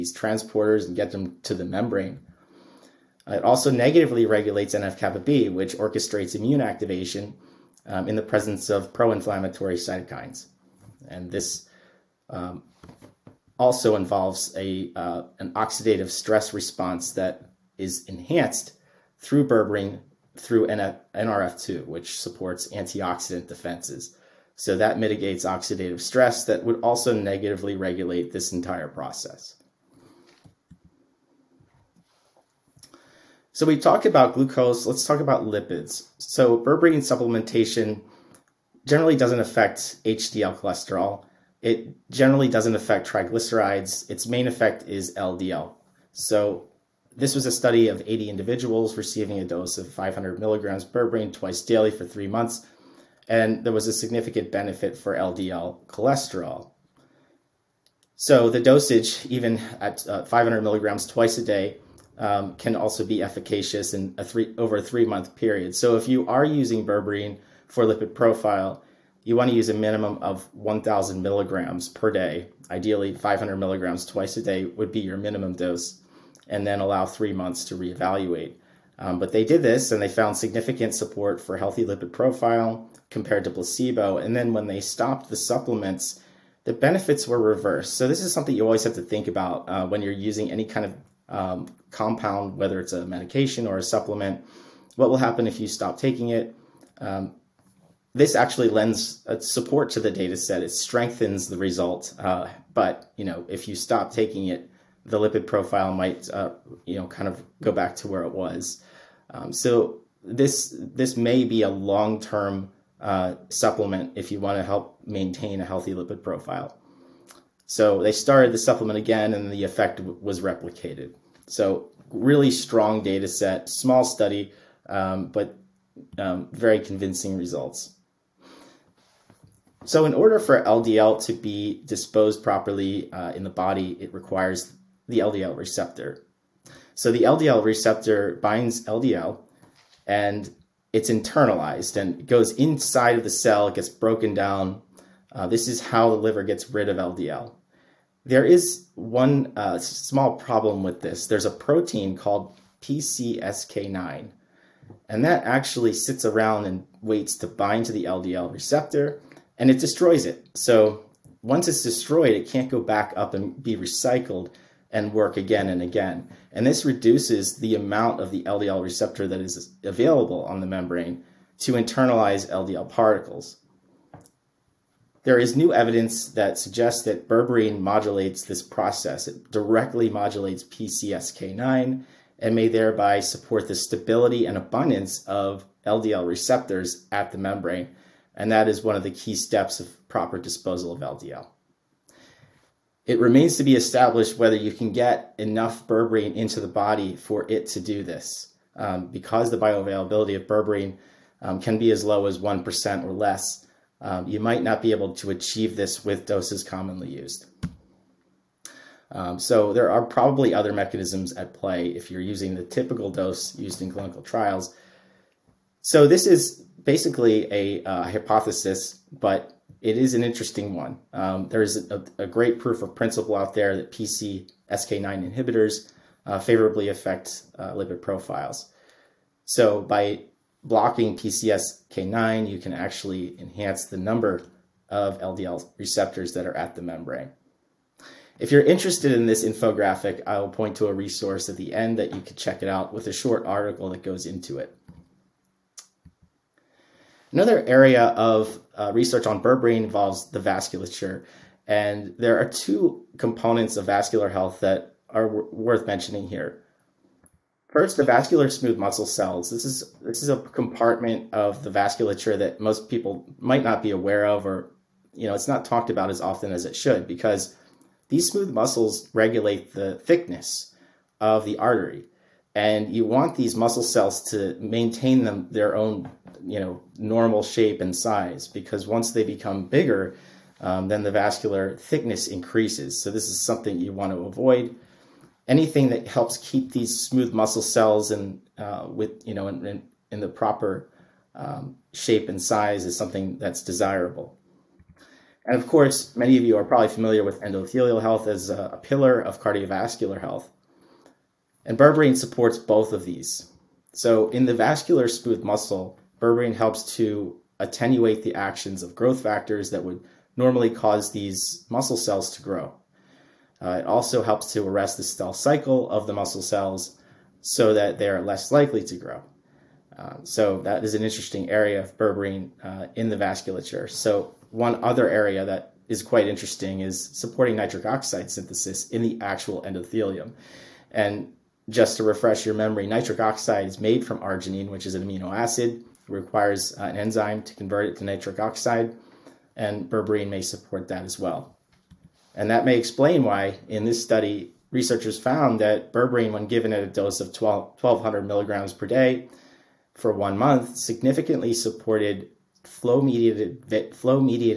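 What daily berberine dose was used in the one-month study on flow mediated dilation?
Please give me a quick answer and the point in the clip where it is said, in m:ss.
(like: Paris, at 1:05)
1200 milligrams, at 5:47.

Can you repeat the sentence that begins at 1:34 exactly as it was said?
What will happen if you stop taking it?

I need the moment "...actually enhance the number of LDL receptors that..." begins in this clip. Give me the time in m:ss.
3:52.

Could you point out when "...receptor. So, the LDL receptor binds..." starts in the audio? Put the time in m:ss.
2:15.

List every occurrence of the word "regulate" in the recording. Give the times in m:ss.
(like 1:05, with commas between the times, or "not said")
0:04, 0:27, 4:29.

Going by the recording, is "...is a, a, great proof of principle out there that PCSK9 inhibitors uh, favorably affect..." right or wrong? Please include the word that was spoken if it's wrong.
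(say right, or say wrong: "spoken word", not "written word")
right.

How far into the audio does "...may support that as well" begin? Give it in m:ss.
5:40.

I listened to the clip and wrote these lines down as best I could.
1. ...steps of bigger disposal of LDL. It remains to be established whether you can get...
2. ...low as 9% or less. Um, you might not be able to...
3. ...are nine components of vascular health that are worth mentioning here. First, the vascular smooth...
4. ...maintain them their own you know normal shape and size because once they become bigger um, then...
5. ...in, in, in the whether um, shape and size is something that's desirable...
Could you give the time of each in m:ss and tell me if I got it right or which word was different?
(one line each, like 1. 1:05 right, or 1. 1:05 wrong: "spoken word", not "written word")
1. 3:09 wrong: "proper", not "bigger"
2. 3:22 wrong: "1", not "9"
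3. 4:12 wrong: "two", not "nine"
4. 4:34 right
5. 4:49 wrong: "proper", not "whether".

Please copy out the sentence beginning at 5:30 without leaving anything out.
And just to refresh your memory, nitric oxide is made from arginine, which is an amino acid.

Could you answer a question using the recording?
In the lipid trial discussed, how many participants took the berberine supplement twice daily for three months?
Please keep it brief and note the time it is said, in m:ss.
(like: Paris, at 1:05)
80, at 0:48.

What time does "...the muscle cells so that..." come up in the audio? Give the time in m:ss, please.
5:16.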